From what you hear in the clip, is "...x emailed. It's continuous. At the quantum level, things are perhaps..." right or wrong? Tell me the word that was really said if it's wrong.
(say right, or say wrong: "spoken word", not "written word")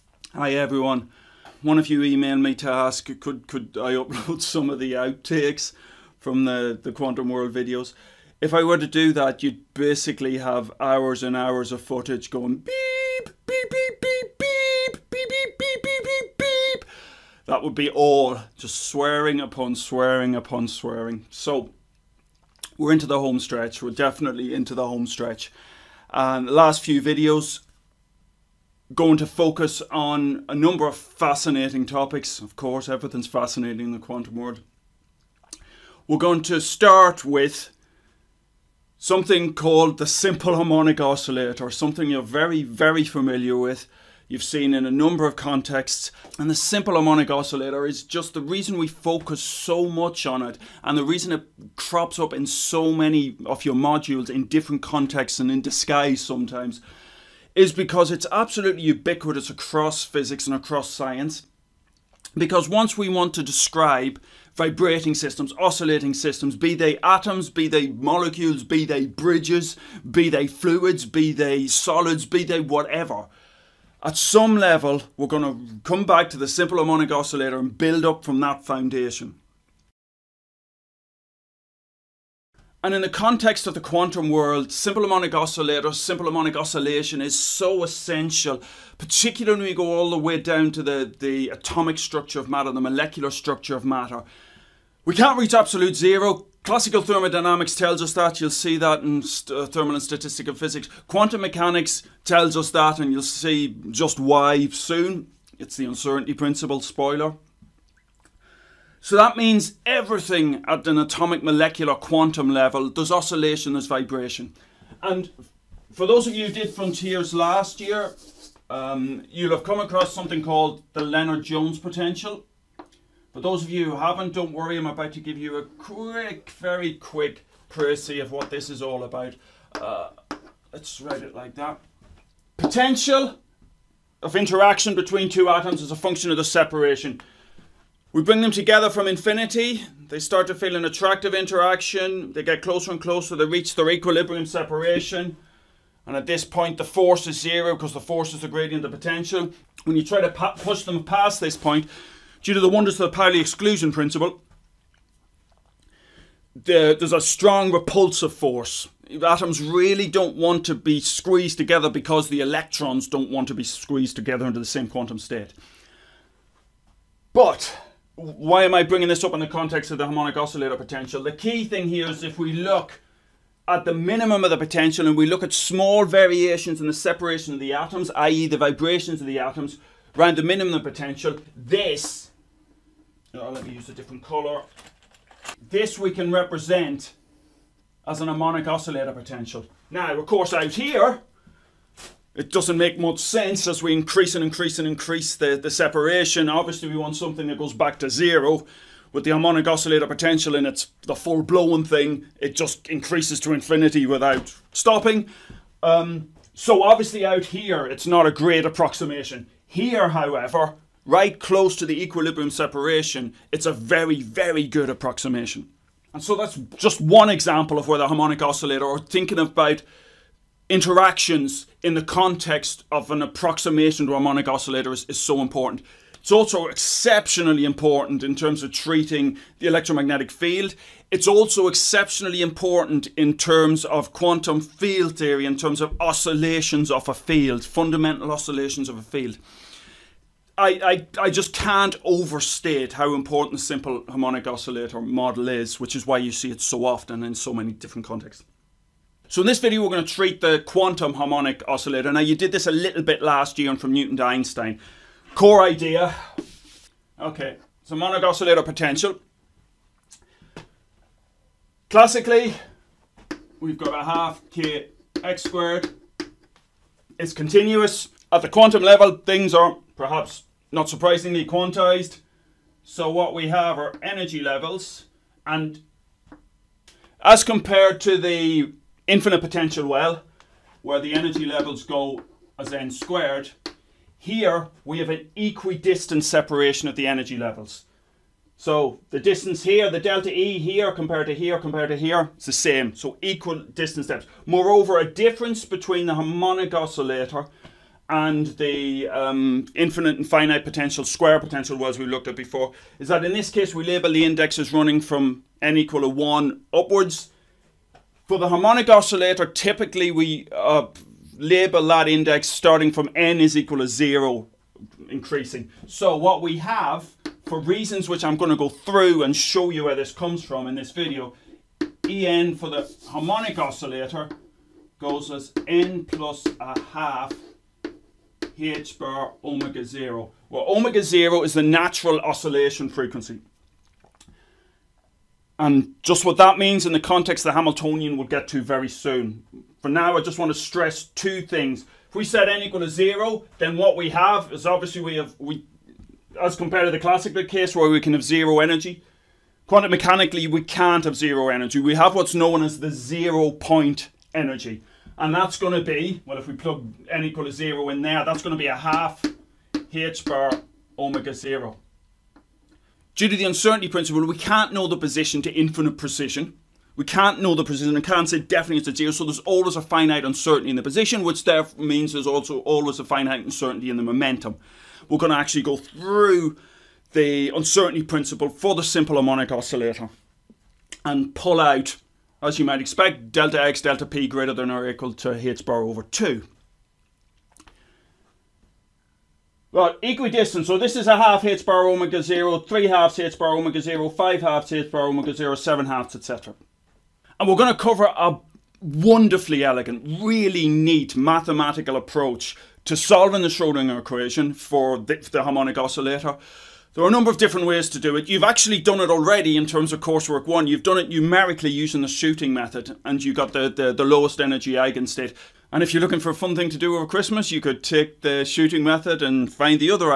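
wrong: "squared", not "emailed".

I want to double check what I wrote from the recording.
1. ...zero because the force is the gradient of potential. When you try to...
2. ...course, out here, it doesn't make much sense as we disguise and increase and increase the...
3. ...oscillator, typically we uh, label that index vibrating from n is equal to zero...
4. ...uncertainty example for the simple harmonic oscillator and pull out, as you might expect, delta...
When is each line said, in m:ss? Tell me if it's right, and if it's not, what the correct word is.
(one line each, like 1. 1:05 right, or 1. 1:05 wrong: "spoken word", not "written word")
1. 2:27 right
2. 3:10 wrong: "increase", not "disguise"
3. 5:08 wrong: "starting", not "vibrating"
4. 6:17 wrong: "principle", not "example".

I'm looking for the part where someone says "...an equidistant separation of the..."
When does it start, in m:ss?
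4:45.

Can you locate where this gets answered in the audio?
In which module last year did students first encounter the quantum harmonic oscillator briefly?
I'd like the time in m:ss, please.
4:13.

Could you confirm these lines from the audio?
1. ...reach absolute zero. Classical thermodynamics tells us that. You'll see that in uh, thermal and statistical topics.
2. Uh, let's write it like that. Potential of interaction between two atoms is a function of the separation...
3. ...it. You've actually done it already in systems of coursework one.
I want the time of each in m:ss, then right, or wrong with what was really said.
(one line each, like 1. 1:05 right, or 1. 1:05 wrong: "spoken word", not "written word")
1. 1:35 wrong: "physics", not "topics"
2. 2:09 right
3. 6:48 wrong: "terms", not "systems".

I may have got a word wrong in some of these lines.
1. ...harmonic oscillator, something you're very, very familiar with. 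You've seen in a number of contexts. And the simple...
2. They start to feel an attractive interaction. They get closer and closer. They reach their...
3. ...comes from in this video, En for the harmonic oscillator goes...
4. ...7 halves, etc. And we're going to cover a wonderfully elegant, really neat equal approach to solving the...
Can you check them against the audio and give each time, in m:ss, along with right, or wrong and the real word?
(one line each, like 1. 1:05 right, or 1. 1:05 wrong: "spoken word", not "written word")
1. 0:40 right
2. 2:20 right
3. 5:20 right
4. 6:35 wrong: "mathematical", not "equal".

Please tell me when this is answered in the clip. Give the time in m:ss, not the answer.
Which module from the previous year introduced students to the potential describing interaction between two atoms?
1:56.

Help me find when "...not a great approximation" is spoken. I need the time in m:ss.
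3:28.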